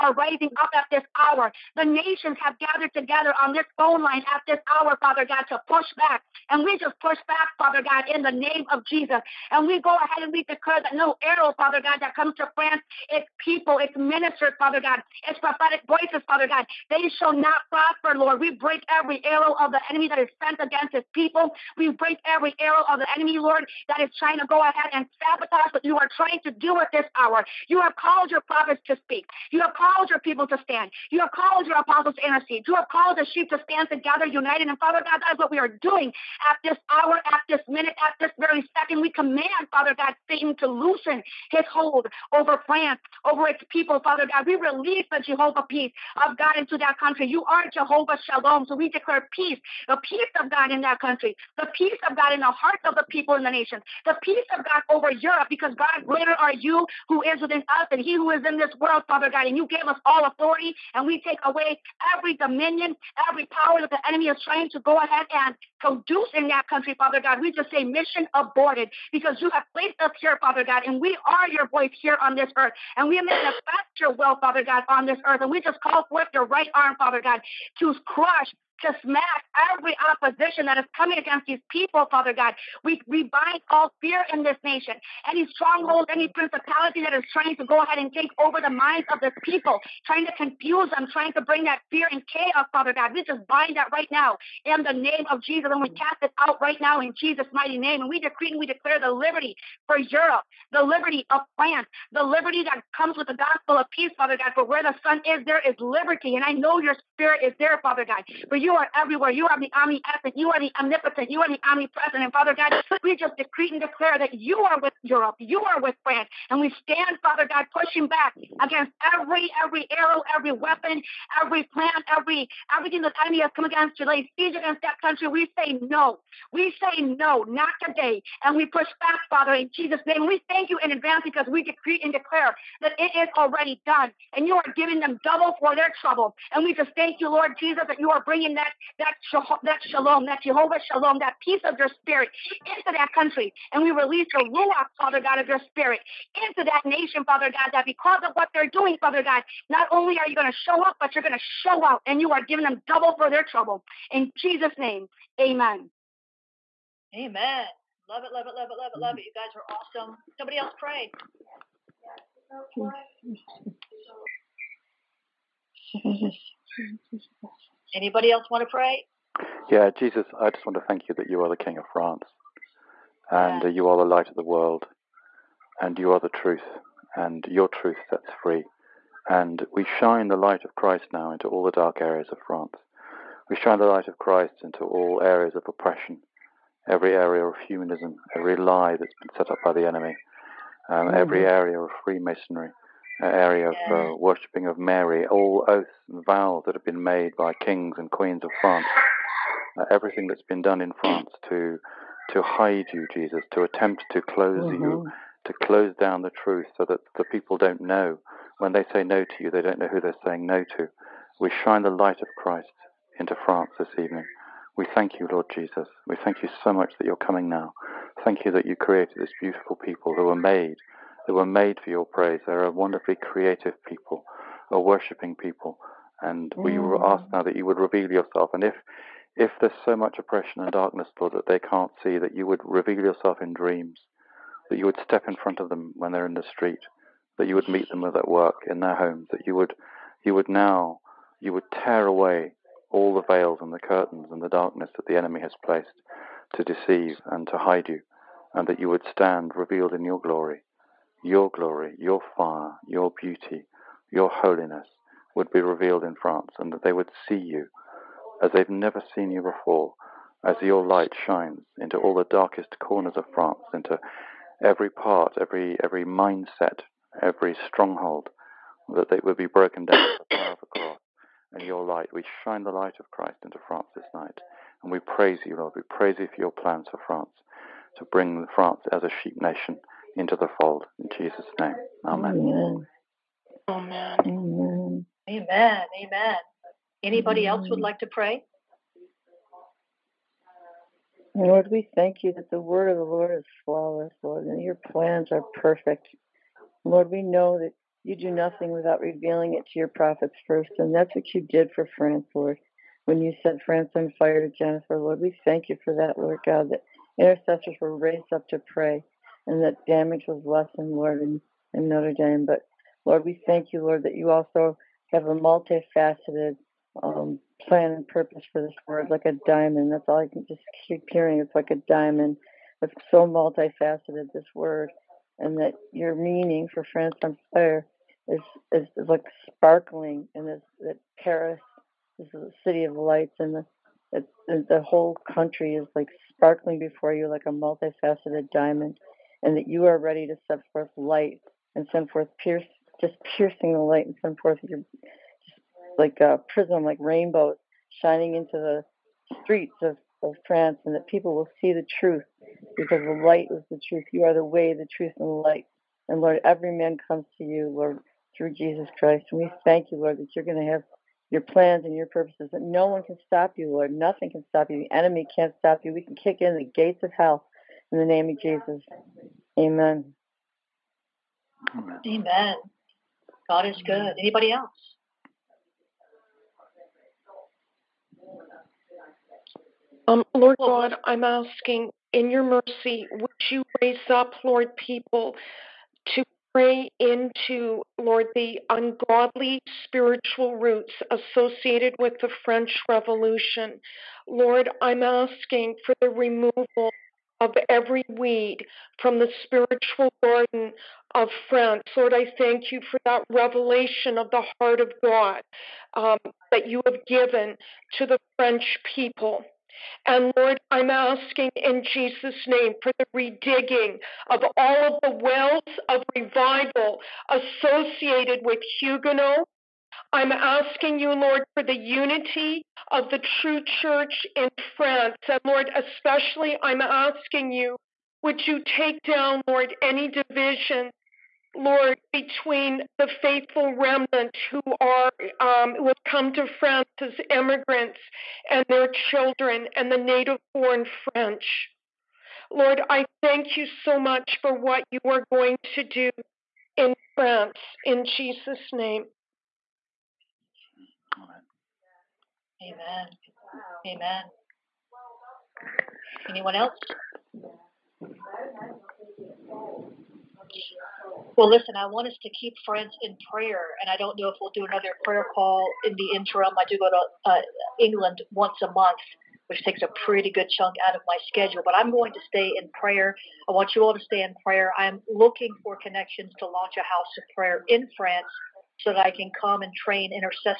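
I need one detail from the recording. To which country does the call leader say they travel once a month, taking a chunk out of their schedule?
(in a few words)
England.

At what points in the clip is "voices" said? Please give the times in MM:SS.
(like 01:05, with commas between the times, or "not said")
00:15, 01:11.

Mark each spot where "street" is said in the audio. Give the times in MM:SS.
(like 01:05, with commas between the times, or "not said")
03:56, 05:49.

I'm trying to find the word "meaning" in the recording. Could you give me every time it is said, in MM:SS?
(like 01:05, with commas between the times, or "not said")
05:26.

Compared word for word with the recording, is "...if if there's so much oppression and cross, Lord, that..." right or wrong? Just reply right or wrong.
wrong.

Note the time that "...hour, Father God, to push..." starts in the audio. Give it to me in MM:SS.
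00:04.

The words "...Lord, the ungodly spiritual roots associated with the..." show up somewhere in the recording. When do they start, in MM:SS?
06:27.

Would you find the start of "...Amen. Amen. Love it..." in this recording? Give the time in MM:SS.
02:35.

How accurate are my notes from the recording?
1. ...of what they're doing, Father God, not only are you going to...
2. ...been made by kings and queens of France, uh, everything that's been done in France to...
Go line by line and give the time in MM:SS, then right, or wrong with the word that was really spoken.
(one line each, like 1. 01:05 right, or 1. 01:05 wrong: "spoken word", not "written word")
1. 02:28 right
2. 03:16 right.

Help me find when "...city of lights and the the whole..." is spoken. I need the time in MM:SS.
05:32.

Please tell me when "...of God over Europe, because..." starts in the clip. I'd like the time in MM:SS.
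00:54.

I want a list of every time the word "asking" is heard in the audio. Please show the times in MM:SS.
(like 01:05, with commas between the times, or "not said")
06:21, 06:35, 06:50, 07:00, 07:06.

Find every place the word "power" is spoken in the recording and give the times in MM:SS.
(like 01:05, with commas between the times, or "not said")
01:03, 04:30.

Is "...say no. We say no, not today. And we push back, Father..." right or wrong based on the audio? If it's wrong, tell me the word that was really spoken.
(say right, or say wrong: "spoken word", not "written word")
right.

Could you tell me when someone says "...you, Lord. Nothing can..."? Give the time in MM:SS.
06:03.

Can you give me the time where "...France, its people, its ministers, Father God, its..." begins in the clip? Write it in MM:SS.
00:12.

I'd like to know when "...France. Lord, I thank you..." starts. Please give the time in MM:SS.
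06:41.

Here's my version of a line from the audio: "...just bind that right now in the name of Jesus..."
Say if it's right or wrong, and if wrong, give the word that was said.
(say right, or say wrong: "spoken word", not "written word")
right.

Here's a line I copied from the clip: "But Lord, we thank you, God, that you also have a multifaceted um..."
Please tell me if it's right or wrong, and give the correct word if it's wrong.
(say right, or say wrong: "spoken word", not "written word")
wrong: "Lord", not "God".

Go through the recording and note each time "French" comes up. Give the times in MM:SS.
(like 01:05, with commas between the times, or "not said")
06:32, 06:48, 07:21.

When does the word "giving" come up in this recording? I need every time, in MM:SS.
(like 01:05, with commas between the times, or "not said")
02:14, 02:32.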